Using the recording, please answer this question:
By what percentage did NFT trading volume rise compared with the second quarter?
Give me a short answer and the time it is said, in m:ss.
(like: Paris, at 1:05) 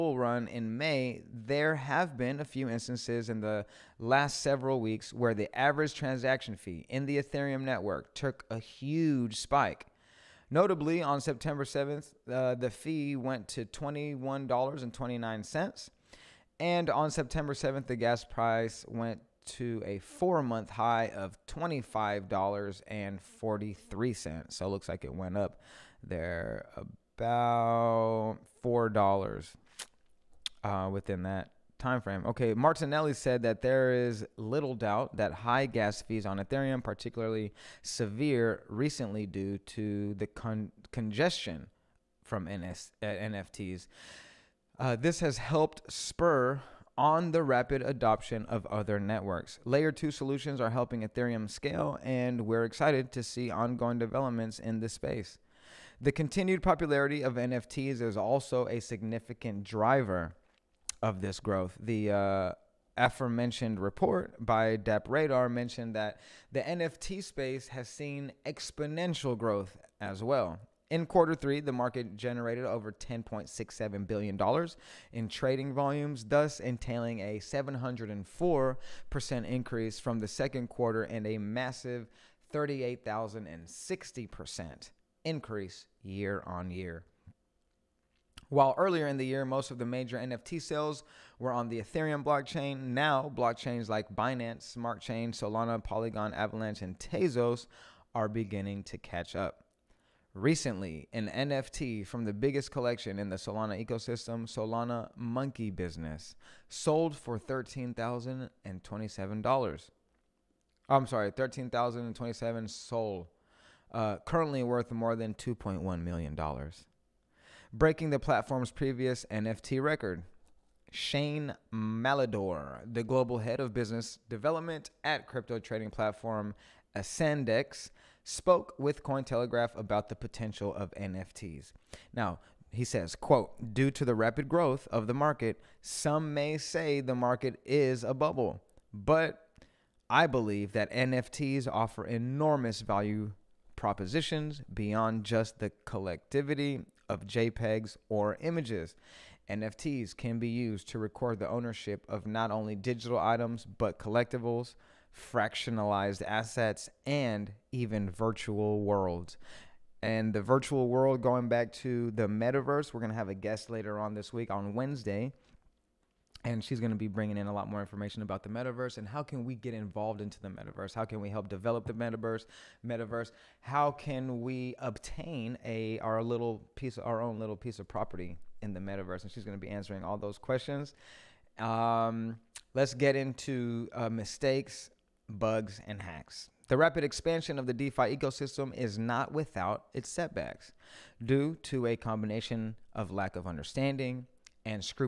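704%, at 1:17.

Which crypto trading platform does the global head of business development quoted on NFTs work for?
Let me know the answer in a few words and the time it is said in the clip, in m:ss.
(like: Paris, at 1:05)
Ascendex, at 2:06.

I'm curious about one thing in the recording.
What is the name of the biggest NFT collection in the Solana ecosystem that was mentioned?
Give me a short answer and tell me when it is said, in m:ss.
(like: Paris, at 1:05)
Solana Monkey Business, at 1:44.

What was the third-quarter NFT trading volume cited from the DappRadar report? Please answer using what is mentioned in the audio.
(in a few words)
$10.67 billion.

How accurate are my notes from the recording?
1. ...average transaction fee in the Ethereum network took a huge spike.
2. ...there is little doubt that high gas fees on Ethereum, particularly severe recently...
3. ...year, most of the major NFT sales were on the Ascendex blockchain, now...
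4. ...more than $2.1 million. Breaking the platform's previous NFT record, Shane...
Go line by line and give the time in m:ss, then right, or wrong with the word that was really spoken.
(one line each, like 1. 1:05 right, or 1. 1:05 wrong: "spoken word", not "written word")
1. 0:05 right
2. 0:33 right
3. 1:29 wrong: "Ethereum", not "Ascendex"
4. 1:54 right.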